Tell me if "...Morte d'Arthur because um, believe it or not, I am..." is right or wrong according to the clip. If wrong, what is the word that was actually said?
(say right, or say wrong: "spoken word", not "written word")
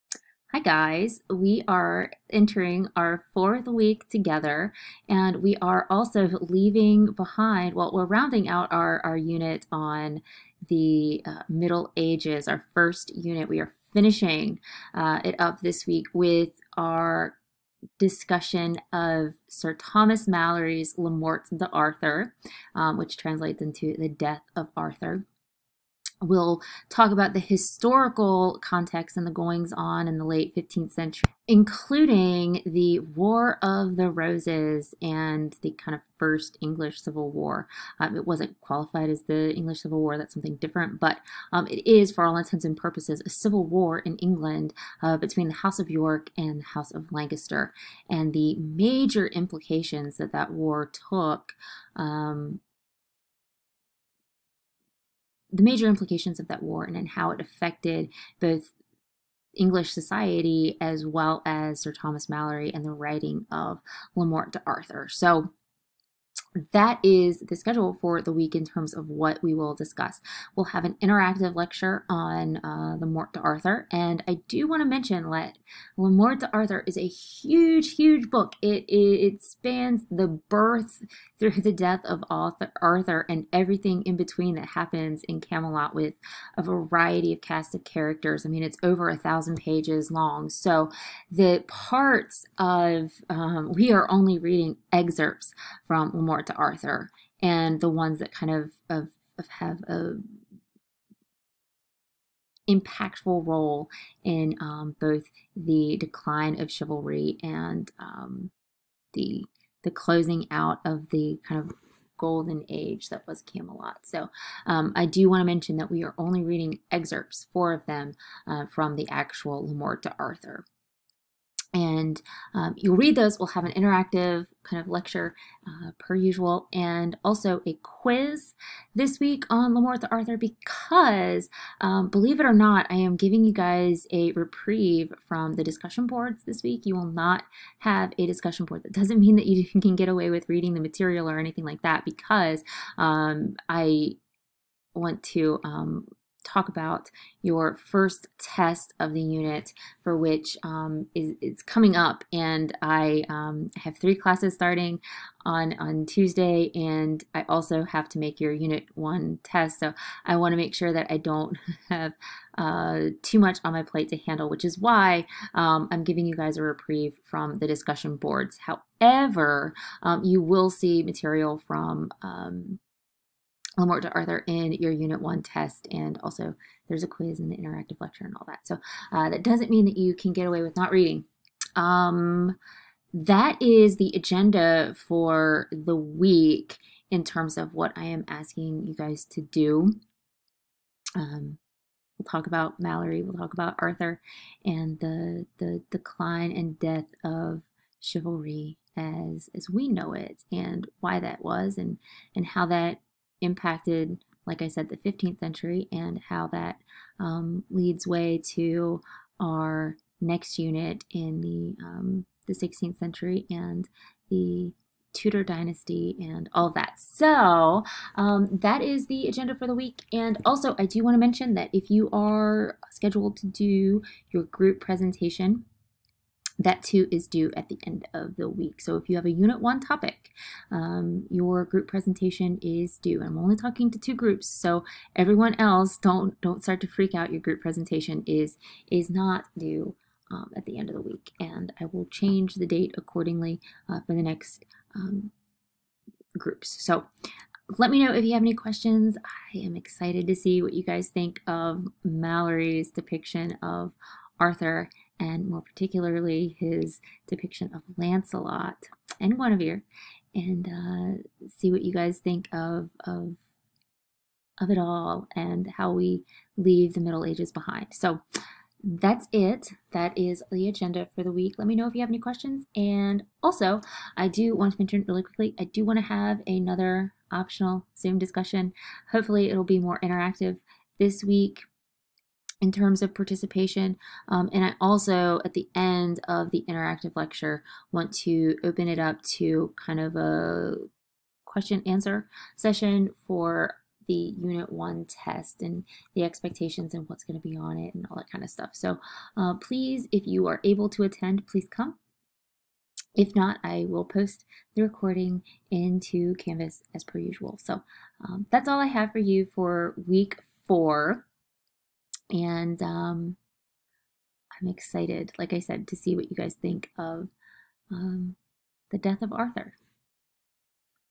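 right.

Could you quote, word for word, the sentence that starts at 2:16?
You will not have a discussion board.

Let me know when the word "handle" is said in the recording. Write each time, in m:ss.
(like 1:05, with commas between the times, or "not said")
2:44.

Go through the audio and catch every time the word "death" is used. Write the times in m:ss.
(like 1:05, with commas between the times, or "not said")
0:24, 1:21, 3:16, 5:18.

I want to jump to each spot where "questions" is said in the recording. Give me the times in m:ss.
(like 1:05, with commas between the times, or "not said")
4:08, 4:32, 4:51.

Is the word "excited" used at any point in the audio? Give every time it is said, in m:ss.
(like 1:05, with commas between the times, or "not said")
4:09, 5:14.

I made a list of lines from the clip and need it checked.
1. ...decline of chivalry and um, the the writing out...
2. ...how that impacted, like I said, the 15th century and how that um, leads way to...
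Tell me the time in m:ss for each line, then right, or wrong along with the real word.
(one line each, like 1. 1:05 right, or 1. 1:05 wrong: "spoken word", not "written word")
1. 1:45 wrong: "closing", not "writing"
2. 3:22 right.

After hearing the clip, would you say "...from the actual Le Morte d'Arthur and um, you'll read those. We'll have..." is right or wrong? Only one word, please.
right.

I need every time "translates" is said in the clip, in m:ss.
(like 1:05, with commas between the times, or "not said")
0:23.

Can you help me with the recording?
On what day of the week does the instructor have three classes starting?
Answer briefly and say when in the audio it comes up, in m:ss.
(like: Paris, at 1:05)
Tuesday, at 2:36.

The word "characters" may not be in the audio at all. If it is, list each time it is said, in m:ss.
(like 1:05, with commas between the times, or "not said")
1:27.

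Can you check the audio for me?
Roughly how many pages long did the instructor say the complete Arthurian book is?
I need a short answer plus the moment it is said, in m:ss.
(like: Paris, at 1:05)
over 1,000 pages, at 1:28.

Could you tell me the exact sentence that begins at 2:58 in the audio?
So uh, that doesn't mean that you can get away with not reading.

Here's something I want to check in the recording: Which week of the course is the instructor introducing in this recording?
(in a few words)
fourth week.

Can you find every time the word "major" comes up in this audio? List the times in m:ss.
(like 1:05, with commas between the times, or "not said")
0:48, 0:55.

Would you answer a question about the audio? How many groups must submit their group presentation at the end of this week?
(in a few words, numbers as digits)
2.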